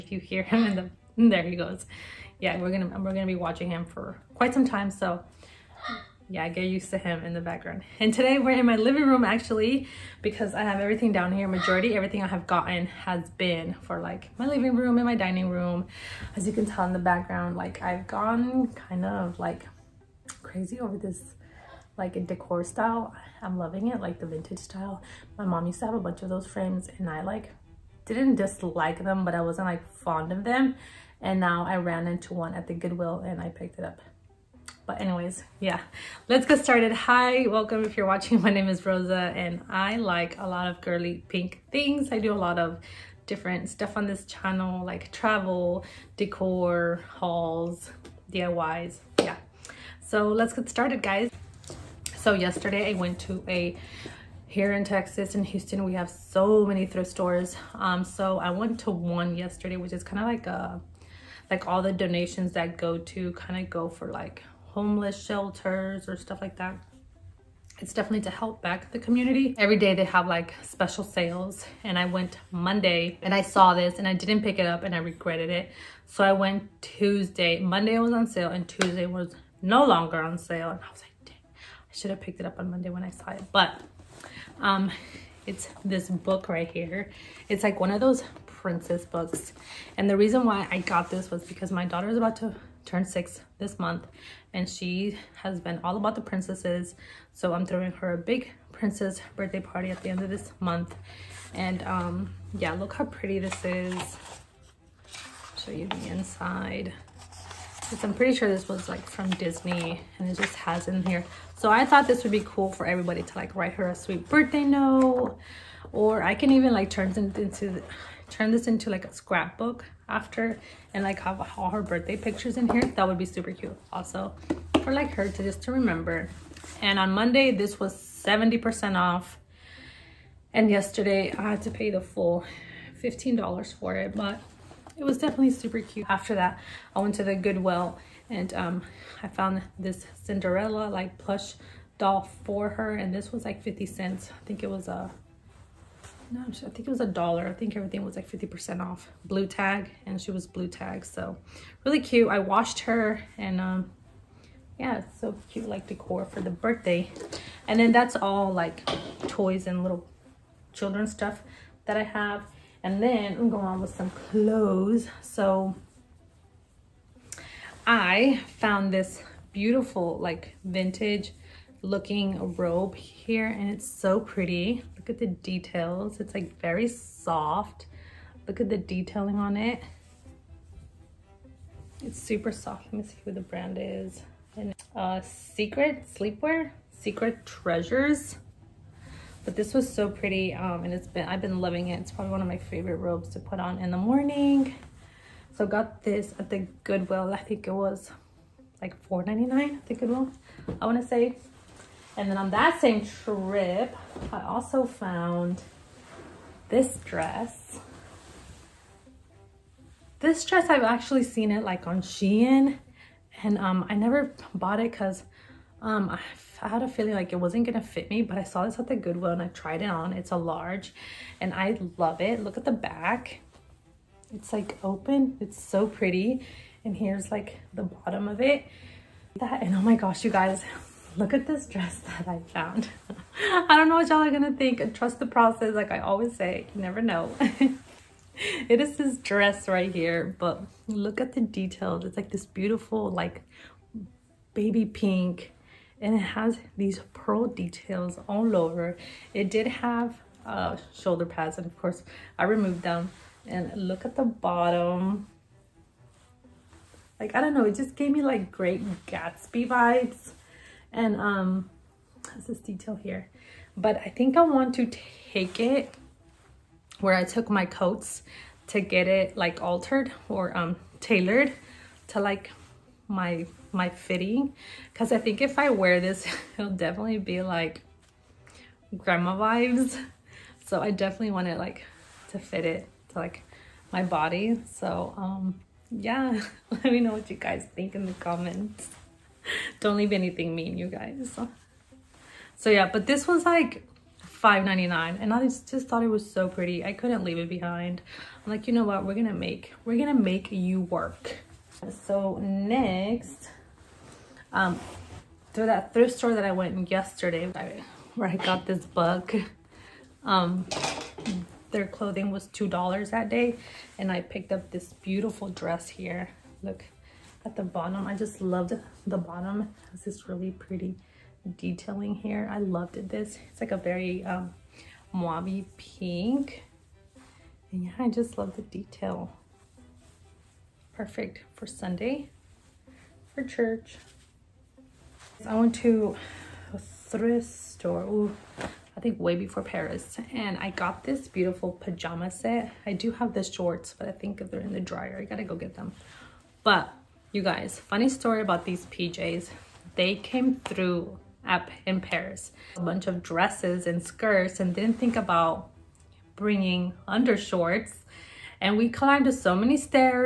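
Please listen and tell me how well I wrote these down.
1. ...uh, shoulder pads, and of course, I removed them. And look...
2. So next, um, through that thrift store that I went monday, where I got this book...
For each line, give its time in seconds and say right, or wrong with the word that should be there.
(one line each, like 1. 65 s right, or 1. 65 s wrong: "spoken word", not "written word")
1. 250 s right
2. 302 s wrong: "yesterday", not "monday".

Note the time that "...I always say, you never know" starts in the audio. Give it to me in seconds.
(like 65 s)
235 s.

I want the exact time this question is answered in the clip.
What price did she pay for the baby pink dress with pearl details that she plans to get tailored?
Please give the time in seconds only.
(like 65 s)
294 s.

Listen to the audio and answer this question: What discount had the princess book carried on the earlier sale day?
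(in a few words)
70 percent off.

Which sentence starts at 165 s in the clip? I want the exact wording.
So I found this beautiful like vintage looking robe here and it's so pretty Look at the details.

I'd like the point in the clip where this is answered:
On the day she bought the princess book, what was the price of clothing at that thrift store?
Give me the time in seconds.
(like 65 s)
312 s.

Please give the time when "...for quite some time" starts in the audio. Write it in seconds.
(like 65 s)
3 s.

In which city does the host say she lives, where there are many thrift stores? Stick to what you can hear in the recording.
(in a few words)
Houston.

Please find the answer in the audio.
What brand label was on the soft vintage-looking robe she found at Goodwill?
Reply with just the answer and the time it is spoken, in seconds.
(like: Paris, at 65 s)
Secret Treasures, at 186 s.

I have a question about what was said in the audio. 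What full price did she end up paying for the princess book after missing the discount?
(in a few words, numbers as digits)
$15.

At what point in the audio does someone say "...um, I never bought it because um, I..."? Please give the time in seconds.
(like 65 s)
213 s.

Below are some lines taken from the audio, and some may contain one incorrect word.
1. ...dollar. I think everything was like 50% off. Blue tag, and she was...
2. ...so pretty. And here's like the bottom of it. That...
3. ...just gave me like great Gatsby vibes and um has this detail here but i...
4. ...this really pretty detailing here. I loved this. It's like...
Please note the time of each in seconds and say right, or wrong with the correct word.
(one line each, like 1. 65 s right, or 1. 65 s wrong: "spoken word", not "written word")
1. 147 s right
2. 225 s right
3. 257 s right
4. 320 s right.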